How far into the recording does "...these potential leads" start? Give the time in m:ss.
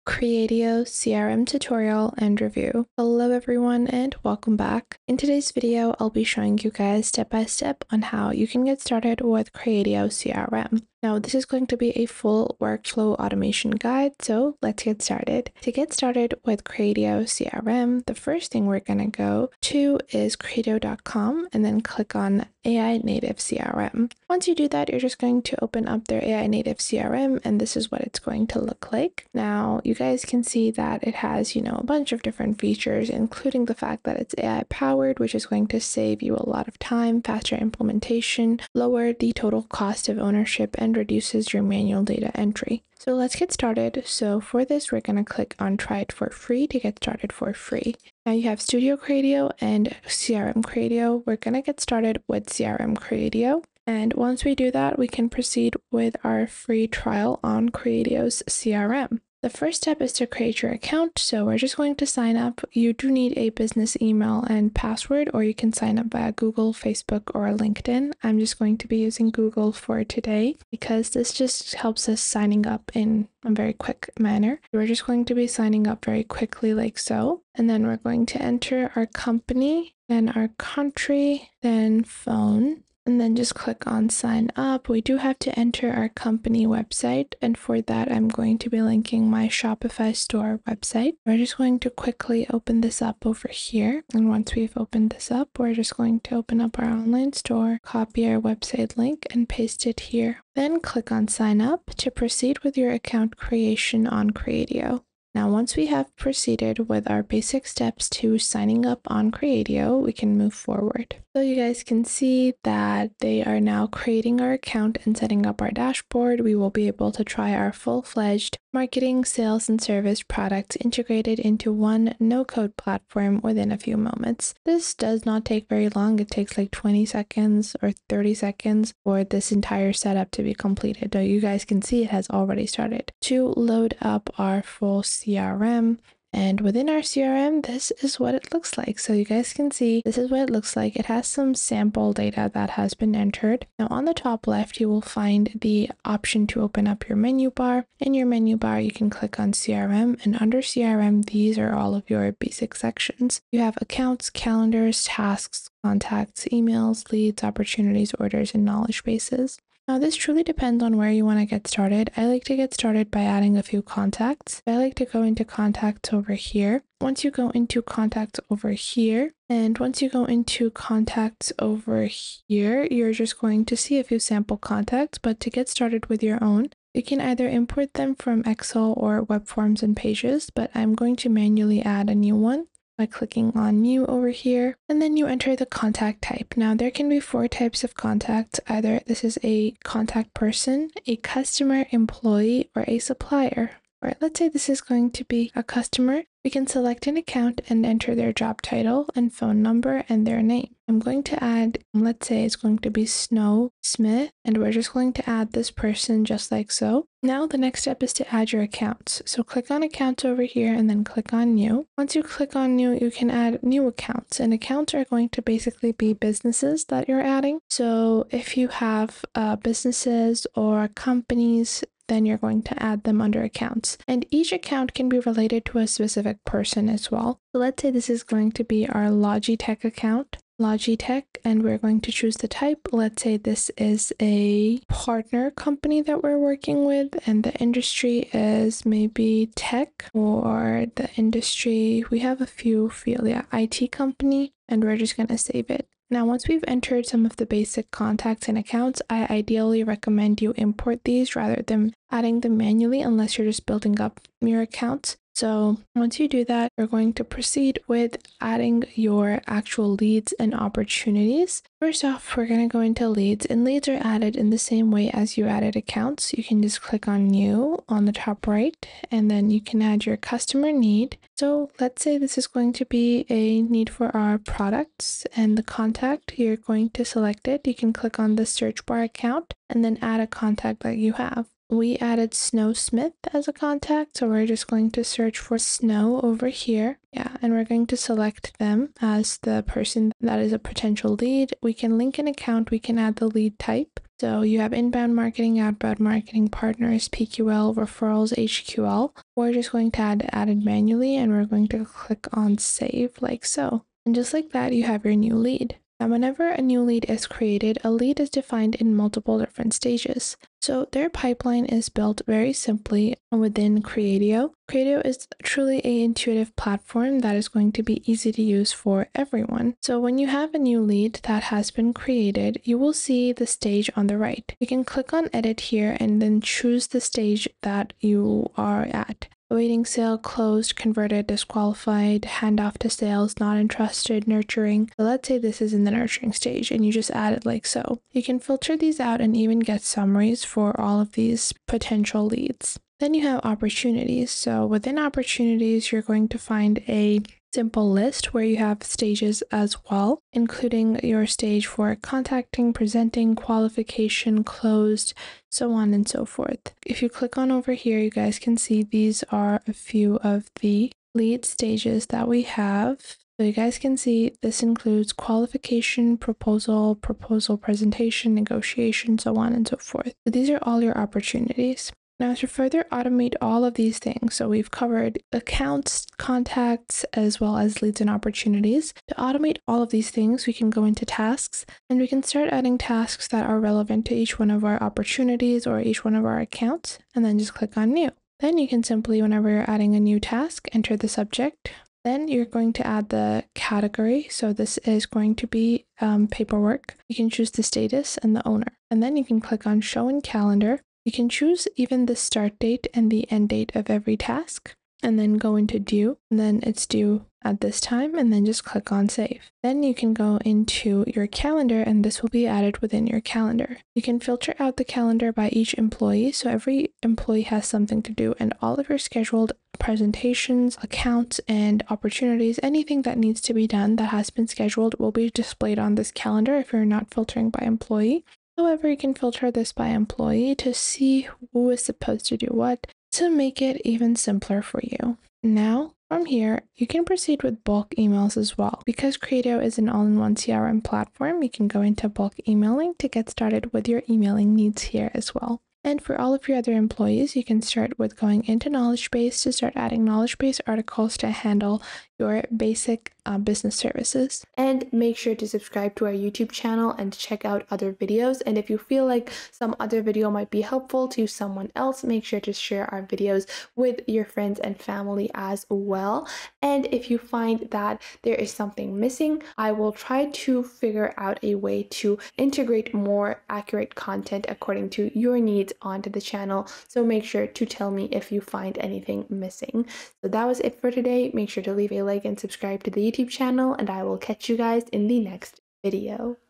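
5:41.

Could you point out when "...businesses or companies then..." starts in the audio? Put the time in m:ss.
3:39.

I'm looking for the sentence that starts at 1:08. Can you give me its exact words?
I'm just going to be using Google for today because this just helps us signing up in a very quick manner.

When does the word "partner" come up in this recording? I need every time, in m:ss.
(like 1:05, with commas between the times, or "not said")
3:54, 4:56.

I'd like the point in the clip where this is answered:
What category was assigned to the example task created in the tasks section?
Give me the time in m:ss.
6:36.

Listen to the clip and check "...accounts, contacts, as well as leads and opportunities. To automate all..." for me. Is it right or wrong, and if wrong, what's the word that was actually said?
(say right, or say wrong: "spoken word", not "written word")
right.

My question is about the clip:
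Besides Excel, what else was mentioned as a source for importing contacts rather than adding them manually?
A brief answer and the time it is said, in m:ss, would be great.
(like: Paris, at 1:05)
Web forms and pages, at 2:59.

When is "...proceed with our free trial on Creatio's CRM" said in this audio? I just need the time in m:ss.
0:55.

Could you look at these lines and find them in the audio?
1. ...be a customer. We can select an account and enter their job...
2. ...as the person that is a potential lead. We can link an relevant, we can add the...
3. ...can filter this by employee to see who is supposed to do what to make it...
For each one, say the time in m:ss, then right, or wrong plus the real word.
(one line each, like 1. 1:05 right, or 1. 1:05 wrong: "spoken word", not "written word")
1. 3:15 right
2. 4:49 wrong: "account", not "relevant"
3. 7:08 right.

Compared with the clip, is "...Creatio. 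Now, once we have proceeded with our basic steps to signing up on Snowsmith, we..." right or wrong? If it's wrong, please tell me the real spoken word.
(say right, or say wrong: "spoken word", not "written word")
wrong: "Creatio", not "Snowsmith".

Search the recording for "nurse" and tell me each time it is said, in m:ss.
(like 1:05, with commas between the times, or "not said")
not said.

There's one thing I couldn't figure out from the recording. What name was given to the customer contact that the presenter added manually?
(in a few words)
Snow Smith.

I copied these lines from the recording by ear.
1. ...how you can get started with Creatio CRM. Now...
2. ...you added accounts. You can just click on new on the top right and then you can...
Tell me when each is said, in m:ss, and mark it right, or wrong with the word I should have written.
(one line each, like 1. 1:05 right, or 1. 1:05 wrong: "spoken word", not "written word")
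1. 0:08 right
2. 4:25 right.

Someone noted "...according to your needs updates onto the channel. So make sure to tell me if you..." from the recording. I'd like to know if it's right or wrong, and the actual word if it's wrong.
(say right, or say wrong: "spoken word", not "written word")
right.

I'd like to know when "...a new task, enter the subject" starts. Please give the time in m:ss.
6:29.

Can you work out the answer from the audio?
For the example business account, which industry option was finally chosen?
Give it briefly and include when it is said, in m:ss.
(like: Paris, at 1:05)
IT company, at 4:03.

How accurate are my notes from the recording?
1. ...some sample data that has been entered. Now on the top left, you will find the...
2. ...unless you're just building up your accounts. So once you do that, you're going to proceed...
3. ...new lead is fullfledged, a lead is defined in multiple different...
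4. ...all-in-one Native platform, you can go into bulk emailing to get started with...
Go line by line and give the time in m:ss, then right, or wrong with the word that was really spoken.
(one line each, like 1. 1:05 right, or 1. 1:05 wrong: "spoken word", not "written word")
1. 2:21 right
2. 4:12 right
3. 5:06 wrong: "created", not "fullfledged"
4. 7:19 wrong: "CRM", not "Native".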